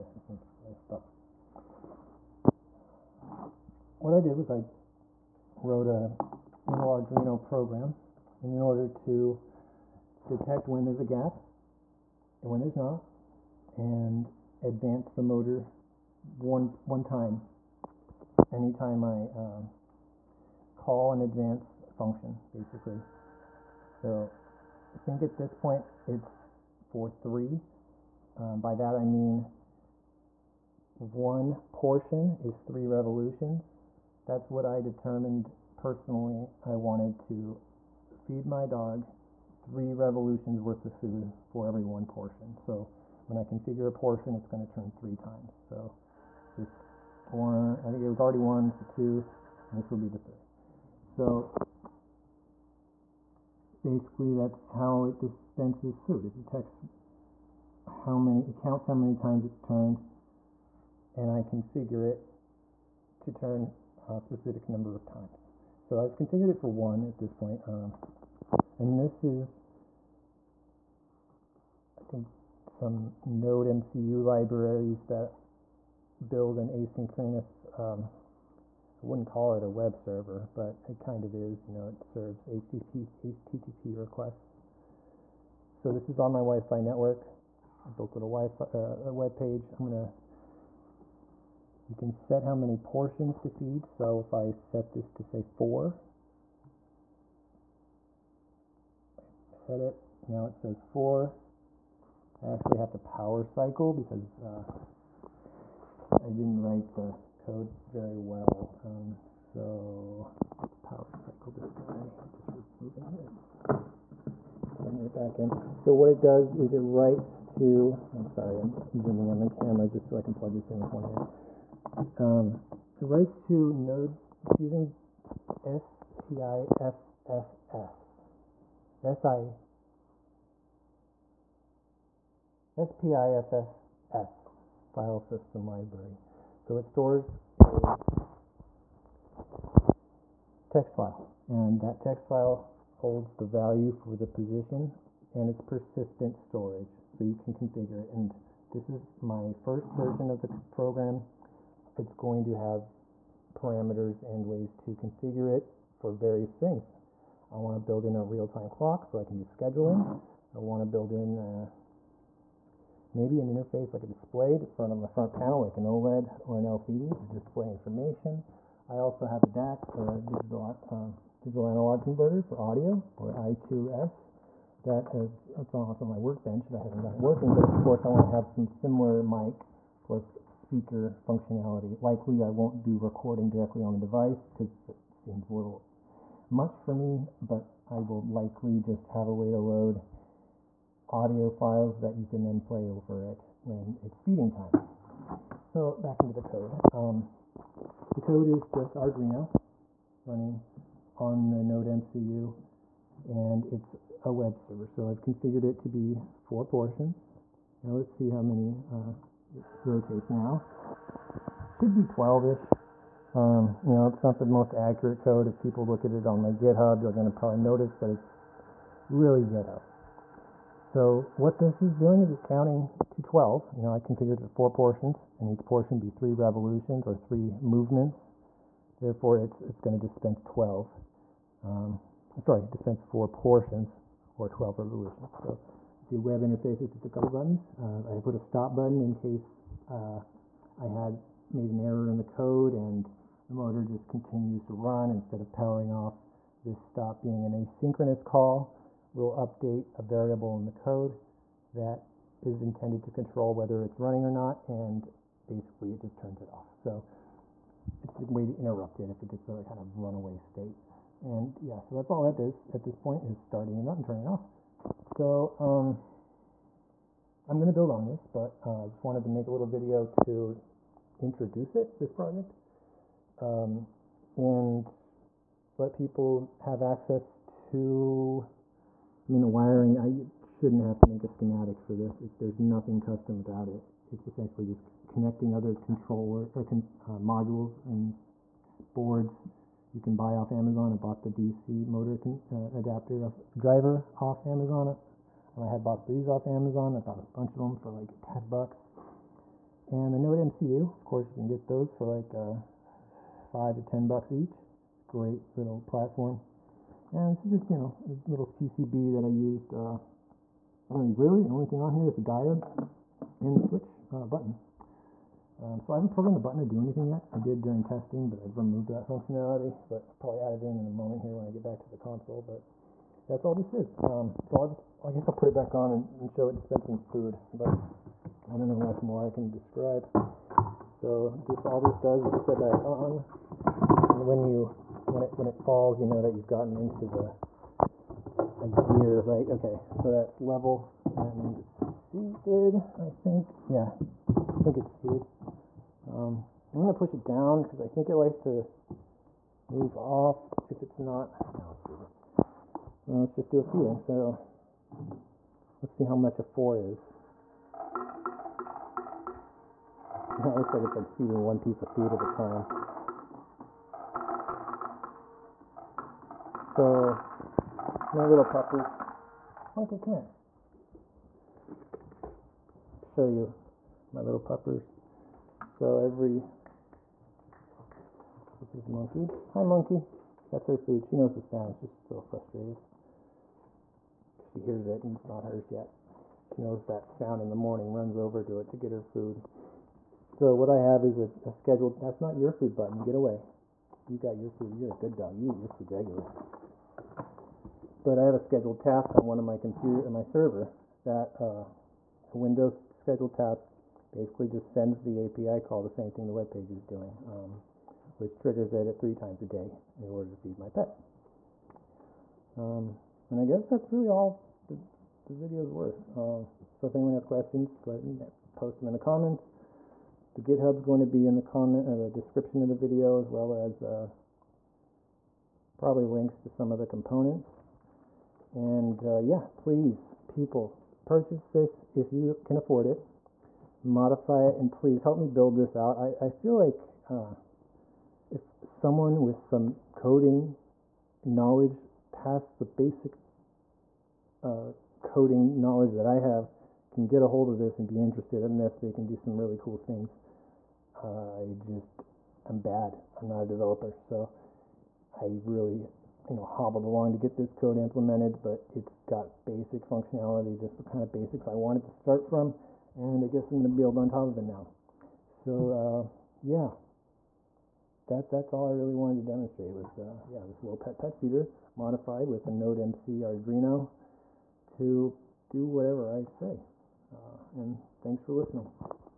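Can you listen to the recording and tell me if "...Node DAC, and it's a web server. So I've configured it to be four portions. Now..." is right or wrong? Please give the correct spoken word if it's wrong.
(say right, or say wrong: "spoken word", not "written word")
wrong: "MCU", not "DAC".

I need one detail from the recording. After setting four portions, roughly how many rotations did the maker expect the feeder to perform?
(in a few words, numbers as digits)
12.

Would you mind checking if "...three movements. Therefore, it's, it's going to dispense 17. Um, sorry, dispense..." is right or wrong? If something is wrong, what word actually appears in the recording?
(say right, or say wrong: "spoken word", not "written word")
wrong: "12", not "17".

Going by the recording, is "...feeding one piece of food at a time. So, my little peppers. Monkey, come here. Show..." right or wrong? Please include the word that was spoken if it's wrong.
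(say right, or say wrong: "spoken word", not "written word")
right.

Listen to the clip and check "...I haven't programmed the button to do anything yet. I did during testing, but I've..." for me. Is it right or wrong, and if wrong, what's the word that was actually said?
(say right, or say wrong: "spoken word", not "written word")
right.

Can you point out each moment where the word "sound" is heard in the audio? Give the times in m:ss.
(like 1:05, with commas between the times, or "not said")
6:21, 6:27.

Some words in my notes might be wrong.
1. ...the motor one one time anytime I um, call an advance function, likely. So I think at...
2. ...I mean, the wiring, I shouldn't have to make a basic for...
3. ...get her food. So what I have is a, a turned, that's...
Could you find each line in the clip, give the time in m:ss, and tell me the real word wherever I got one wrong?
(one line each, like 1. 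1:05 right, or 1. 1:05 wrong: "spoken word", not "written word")
1. 0:15 wrong: "basically", not "likely"
2. 4:39 wrong: "schematic", not "basic"
3. 6:28 wrong: "scheduled", not "turned".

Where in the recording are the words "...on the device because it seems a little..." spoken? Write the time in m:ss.
3:03.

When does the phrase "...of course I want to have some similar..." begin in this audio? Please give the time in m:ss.
2:57.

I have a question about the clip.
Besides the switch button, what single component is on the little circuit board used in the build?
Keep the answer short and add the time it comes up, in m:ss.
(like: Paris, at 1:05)
diode, at 5:12.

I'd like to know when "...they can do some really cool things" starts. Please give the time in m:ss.
7:28.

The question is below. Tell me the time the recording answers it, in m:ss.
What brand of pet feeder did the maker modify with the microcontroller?
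7:50.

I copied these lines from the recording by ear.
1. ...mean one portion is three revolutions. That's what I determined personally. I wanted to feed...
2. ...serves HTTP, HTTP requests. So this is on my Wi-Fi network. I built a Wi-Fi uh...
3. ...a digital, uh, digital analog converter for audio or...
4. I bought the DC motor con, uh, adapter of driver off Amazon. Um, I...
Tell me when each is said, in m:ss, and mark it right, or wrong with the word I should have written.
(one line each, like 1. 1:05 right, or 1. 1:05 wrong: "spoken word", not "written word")
1. 0:29 right
2. 1:22 right
3. 2:50 right
4. 4:50 right.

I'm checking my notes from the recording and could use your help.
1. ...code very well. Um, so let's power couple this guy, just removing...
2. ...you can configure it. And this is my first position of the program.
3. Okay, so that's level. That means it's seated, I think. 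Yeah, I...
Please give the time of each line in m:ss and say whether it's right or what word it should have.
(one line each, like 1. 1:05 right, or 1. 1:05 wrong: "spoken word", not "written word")
1. 1:47 wrong: "cycle", not "couple"
2. 2:27 wrong: "version", not "position"
3. 5:39 right.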